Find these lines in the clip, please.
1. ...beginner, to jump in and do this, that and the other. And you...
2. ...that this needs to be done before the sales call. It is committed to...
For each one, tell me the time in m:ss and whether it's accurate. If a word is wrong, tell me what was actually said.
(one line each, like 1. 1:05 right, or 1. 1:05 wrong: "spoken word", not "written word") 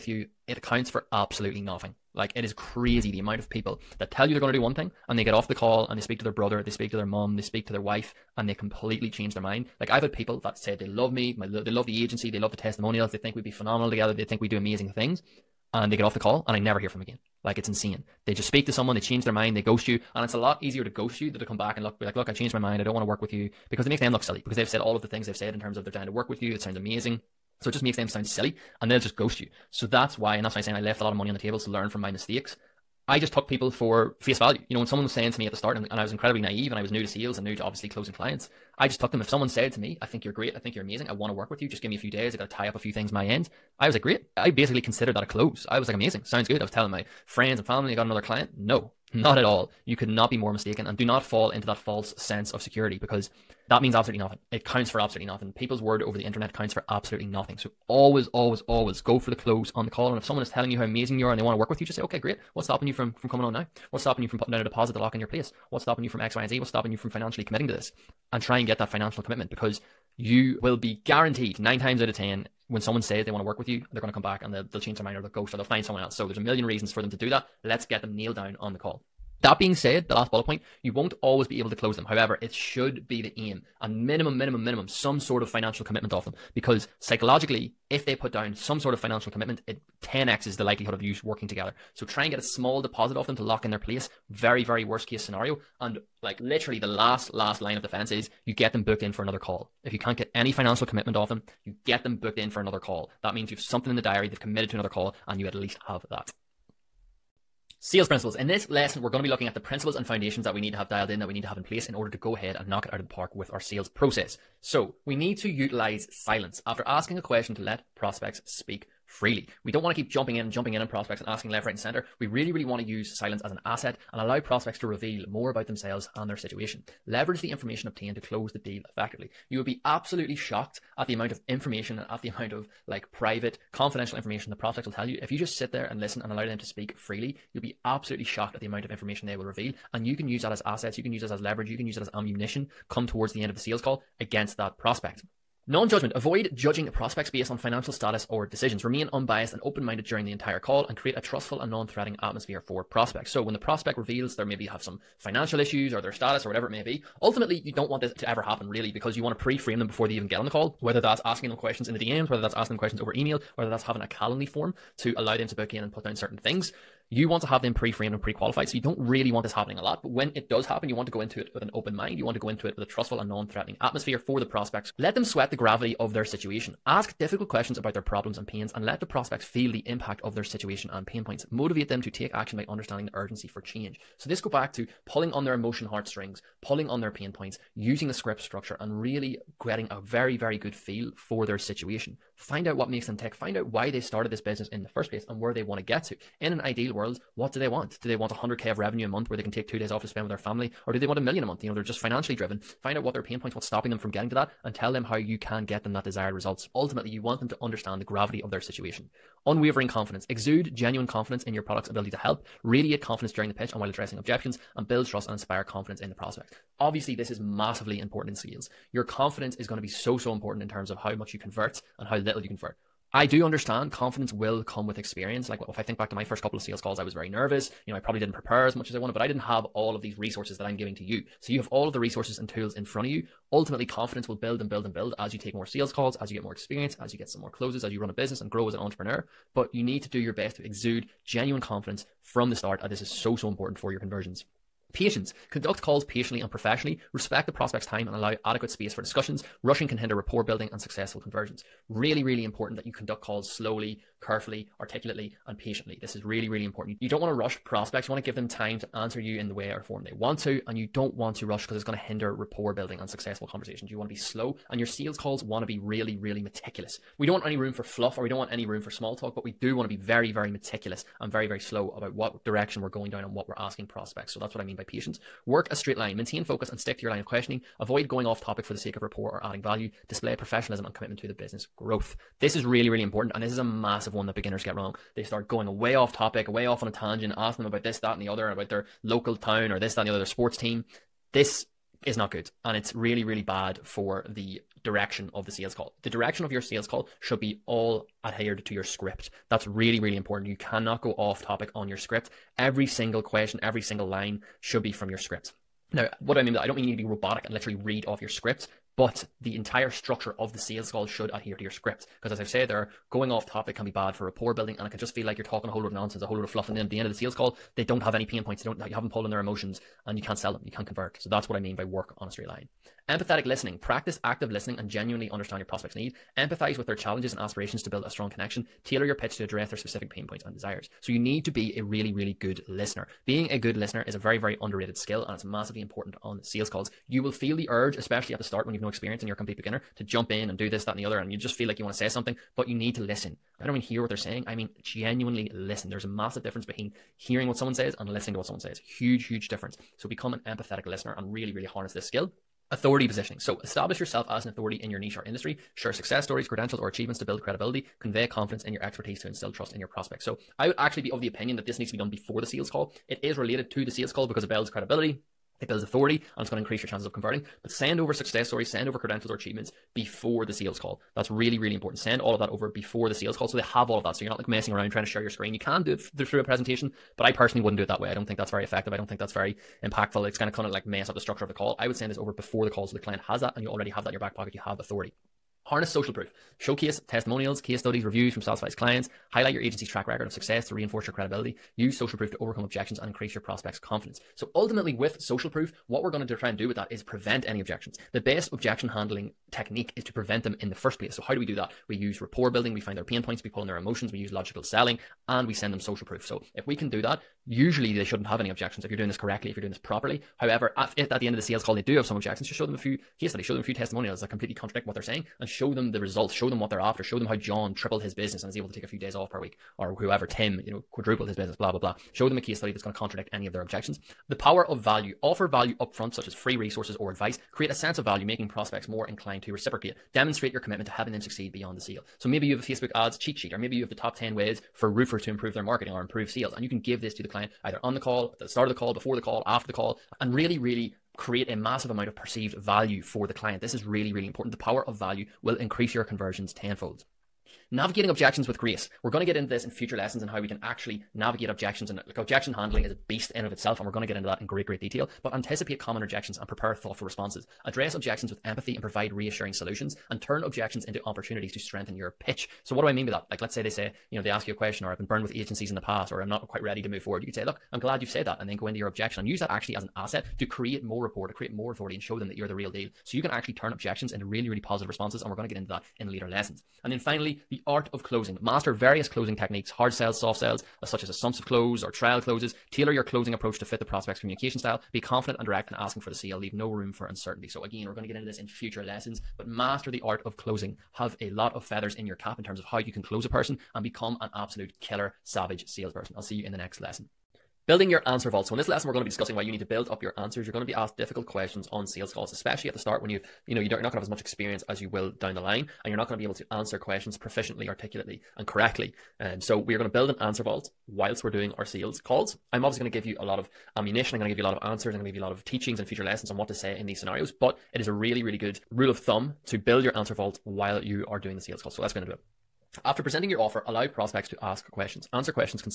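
1. 5:39 right
2. 6:01 wrong: "related", not "committed".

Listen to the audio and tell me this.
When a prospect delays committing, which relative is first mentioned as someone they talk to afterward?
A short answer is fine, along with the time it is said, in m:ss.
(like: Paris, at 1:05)
brother, at 0:06.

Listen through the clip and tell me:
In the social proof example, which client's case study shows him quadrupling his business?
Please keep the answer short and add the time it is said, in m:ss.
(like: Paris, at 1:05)
Tim, at 7:00.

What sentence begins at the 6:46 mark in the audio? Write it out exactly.
So if we can do that, Usually they shouldn't have any objections if you're doing this correctly, if you're doing this properly.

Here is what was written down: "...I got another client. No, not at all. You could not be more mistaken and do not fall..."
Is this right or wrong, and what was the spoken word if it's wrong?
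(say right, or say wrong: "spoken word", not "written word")
right.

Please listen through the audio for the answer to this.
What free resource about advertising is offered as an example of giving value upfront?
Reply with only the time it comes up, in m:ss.
7:12.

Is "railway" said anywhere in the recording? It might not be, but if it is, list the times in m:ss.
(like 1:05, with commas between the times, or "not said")
not said.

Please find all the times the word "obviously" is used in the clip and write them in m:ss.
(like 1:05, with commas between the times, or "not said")
0:37, 3:36, 8:32.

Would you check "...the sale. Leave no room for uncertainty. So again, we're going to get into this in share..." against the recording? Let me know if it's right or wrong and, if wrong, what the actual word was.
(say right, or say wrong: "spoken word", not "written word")
wrong: "future", not "share".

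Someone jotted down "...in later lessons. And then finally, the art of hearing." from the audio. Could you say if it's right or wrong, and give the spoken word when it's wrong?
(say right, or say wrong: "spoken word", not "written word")
wrong: "closing", not "hearing".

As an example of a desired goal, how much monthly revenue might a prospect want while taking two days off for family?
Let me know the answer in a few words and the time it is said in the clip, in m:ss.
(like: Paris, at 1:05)
100k, at 3:18.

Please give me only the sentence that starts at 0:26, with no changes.
It sounds amazing, so it just makes them sound silly, and they'll just ghost you.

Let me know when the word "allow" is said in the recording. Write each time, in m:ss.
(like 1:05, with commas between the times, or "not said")
2:04, 2:16, 2:45, 4:08, 8:43.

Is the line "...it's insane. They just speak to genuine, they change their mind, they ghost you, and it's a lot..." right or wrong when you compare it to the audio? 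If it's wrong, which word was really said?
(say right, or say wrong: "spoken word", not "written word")
wrong: "someone", not "genuine".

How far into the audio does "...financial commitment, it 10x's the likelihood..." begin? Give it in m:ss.
1:28.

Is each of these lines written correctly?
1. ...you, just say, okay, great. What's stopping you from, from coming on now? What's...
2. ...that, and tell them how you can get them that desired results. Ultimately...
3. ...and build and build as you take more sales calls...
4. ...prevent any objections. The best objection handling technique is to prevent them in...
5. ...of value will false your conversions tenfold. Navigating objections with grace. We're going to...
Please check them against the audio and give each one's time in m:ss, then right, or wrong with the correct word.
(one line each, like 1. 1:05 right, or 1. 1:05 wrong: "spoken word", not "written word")
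1. 1:01 right
2. 3:24 right
3. 3:54 right
4. 6:37 right
5. 7:24 wrong: "increase", not "false".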